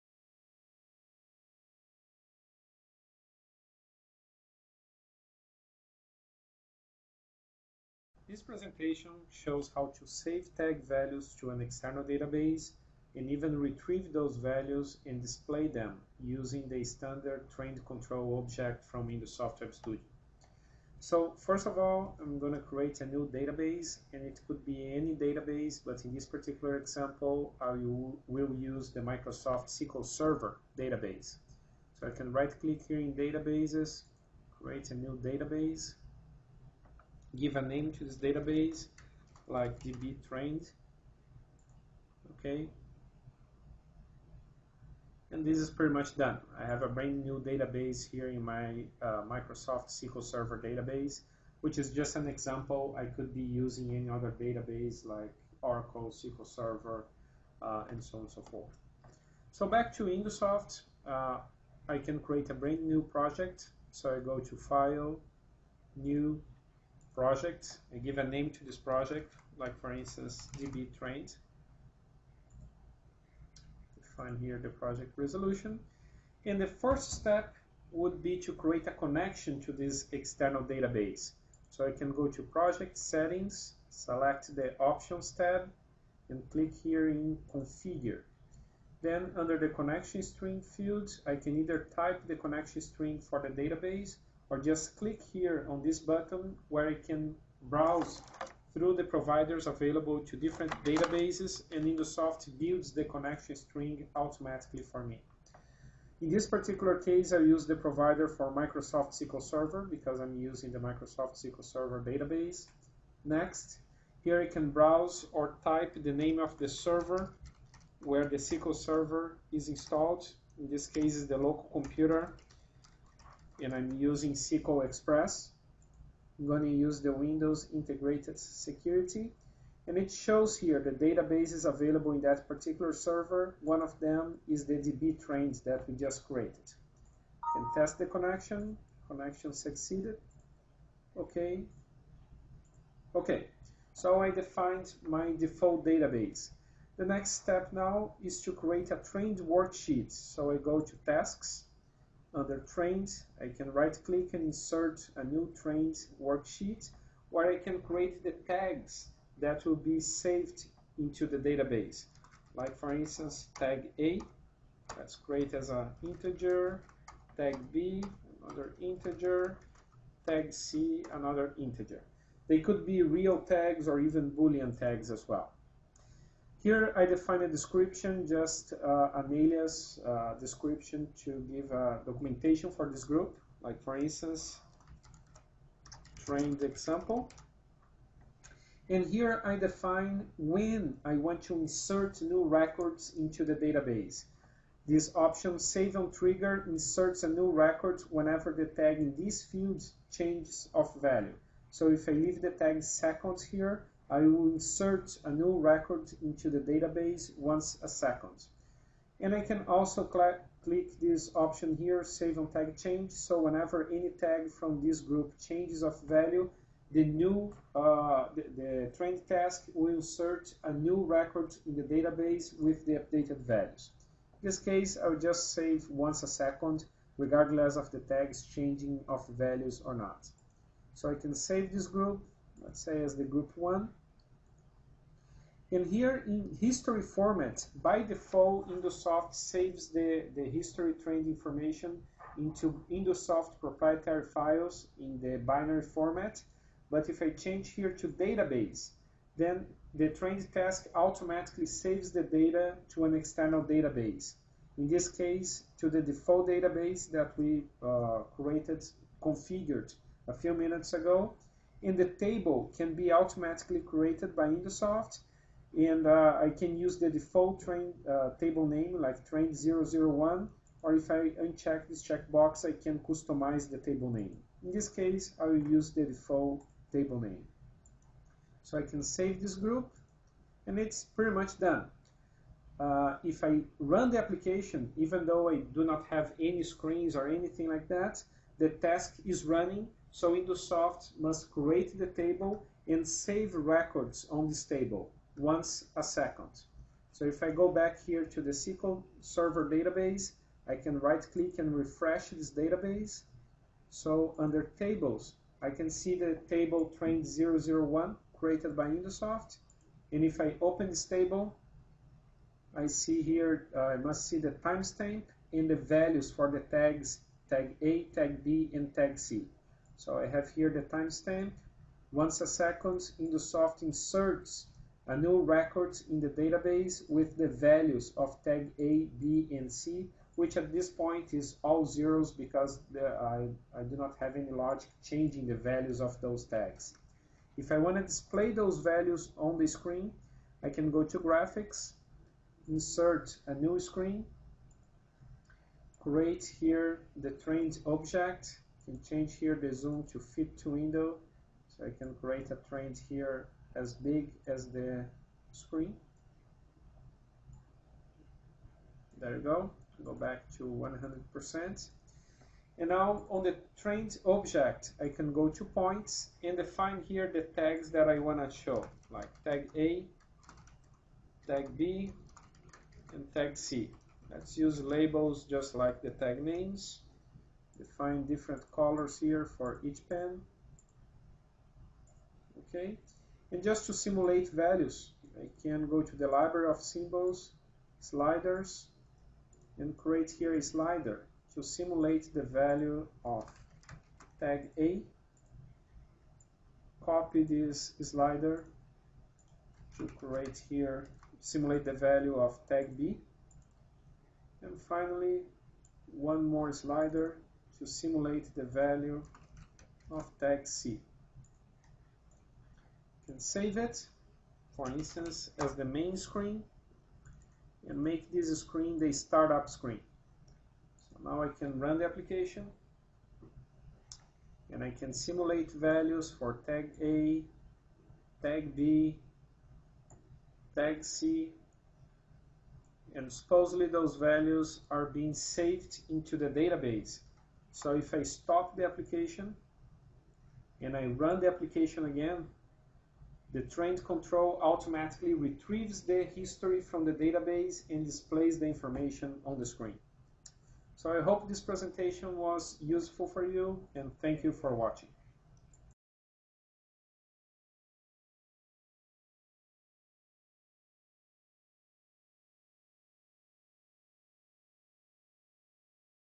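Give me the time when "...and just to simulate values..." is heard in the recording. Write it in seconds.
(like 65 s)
383 s.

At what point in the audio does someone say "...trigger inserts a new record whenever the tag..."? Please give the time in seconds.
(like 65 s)
196 s.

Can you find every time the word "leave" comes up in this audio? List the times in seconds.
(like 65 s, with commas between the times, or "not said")
202 s.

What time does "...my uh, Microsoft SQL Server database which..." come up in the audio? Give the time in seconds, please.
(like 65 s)
48 s.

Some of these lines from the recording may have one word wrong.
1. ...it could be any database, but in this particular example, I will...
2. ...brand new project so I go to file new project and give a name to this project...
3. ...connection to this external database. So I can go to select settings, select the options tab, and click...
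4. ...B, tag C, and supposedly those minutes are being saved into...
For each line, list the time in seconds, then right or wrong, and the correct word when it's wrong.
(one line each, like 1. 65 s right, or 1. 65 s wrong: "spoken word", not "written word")
1. 24 s right
2. 62 s right
3. 78 s wrong: "project", not "select"
4. 428 s wrong: "values", not "minutes".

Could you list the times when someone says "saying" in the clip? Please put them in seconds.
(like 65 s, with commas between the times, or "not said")
not said.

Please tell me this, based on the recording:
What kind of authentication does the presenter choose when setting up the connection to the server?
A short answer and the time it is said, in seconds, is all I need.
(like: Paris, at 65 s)
Windows Integrated Security, at 127 s.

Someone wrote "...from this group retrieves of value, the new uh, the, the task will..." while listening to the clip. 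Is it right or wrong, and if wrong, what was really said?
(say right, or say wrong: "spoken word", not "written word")
wrong: "changes", not "retrieves".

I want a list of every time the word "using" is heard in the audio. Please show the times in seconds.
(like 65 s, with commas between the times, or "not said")
16 s, 53 s, 110 s, 123 s.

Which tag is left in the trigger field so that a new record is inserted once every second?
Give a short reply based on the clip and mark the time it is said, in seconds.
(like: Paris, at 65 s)
seconds, at 202 s.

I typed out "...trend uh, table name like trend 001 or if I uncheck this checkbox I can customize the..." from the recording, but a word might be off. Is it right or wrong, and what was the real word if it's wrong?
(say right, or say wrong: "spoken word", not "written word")
right.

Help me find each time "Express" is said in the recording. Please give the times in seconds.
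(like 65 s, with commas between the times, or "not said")
124 s.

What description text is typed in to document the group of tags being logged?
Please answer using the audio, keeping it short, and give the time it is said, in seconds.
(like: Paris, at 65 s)
trend example, at 186 s.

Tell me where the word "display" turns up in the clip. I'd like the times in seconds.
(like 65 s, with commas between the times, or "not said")
15 s, 338 s, 448 s.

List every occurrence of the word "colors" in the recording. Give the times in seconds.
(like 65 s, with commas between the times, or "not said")
378 s.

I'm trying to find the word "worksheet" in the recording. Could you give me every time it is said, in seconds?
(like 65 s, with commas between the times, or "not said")
149 s, 156 s.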